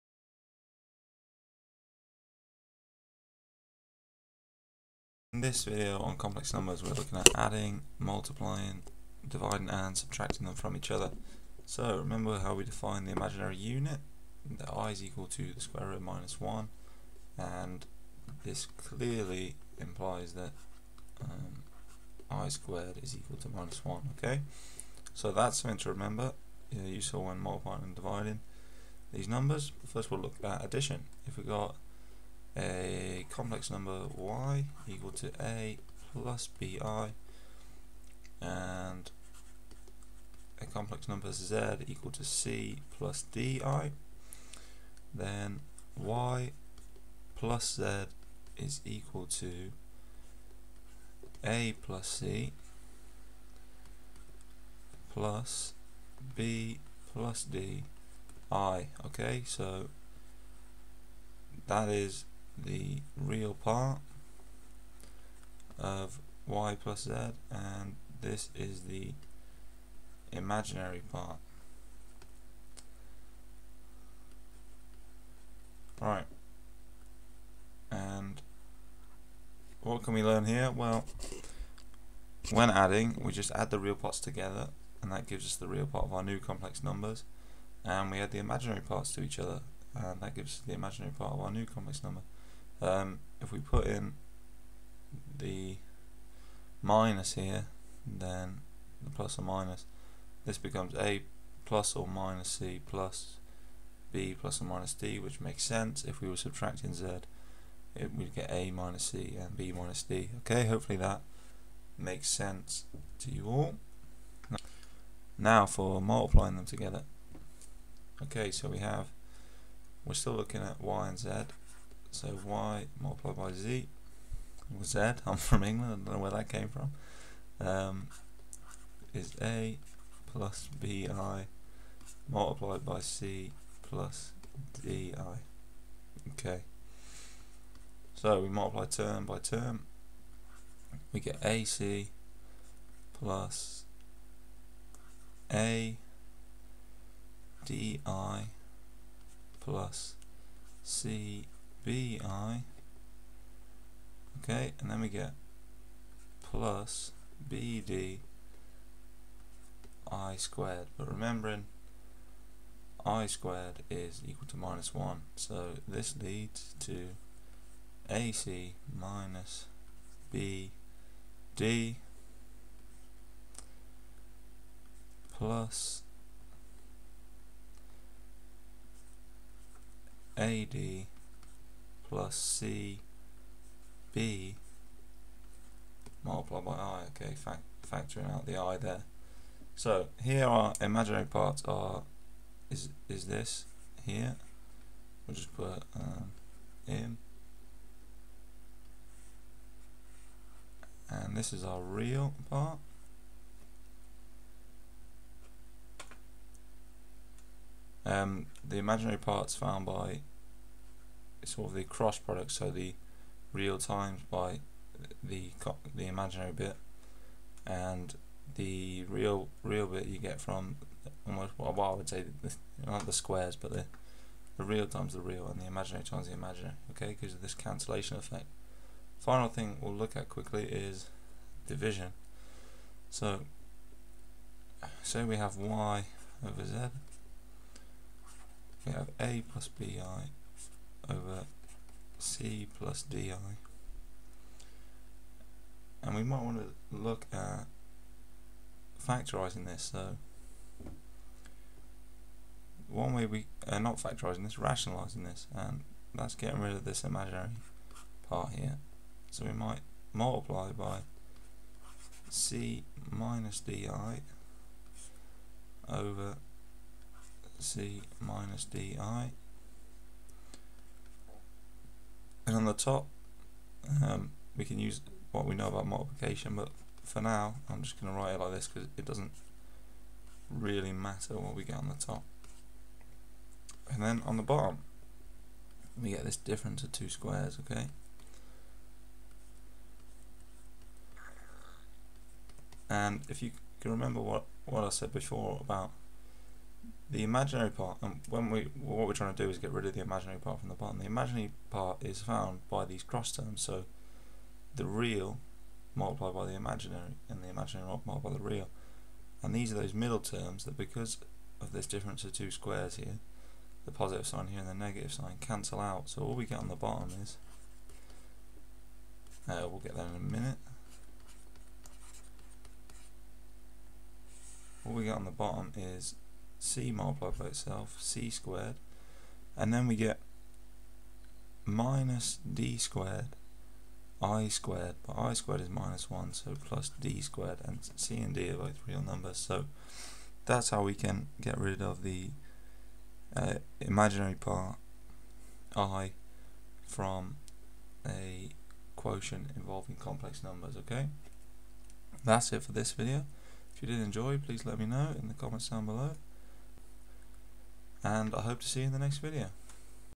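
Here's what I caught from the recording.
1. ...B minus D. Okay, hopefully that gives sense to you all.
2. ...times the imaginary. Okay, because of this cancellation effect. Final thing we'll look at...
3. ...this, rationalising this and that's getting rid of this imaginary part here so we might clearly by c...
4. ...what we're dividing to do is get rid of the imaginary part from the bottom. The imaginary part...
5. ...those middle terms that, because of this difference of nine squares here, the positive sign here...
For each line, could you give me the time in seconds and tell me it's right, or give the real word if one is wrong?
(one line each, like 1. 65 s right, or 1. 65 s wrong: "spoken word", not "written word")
1. 109 s wrong: "makes", not "gives"
2. 226 s right
3. 254 s wrong: "multiply", not "clearly"
4. 298 s wrong: "trying", not "dividing"
5. 309 s wrong: "two", not "nine".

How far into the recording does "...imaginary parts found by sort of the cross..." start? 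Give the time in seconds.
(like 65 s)
208 s.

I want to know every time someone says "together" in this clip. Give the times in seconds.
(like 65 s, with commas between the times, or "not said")
84 s, 116 s.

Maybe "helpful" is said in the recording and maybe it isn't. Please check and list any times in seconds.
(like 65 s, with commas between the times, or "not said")
not said.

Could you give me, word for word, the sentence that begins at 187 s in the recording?
Okay, fact factoring out the I there.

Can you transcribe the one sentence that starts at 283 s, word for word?
And then on the bottom, we get this difference of two squares, okay?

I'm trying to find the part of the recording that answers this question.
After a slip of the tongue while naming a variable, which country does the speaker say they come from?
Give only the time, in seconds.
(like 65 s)
125 s.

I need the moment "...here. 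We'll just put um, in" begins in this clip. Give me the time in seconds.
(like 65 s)
194 s.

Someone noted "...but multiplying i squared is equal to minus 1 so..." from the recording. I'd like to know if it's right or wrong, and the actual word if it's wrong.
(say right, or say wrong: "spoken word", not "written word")
wrong: "remembering", not "multiplying".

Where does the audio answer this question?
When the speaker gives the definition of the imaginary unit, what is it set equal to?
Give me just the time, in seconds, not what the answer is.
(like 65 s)
15 s.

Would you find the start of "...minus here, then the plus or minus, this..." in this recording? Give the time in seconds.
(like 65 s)
96 s.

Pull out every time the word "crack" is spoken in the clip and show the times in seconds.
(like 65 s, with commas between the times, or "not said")
not said.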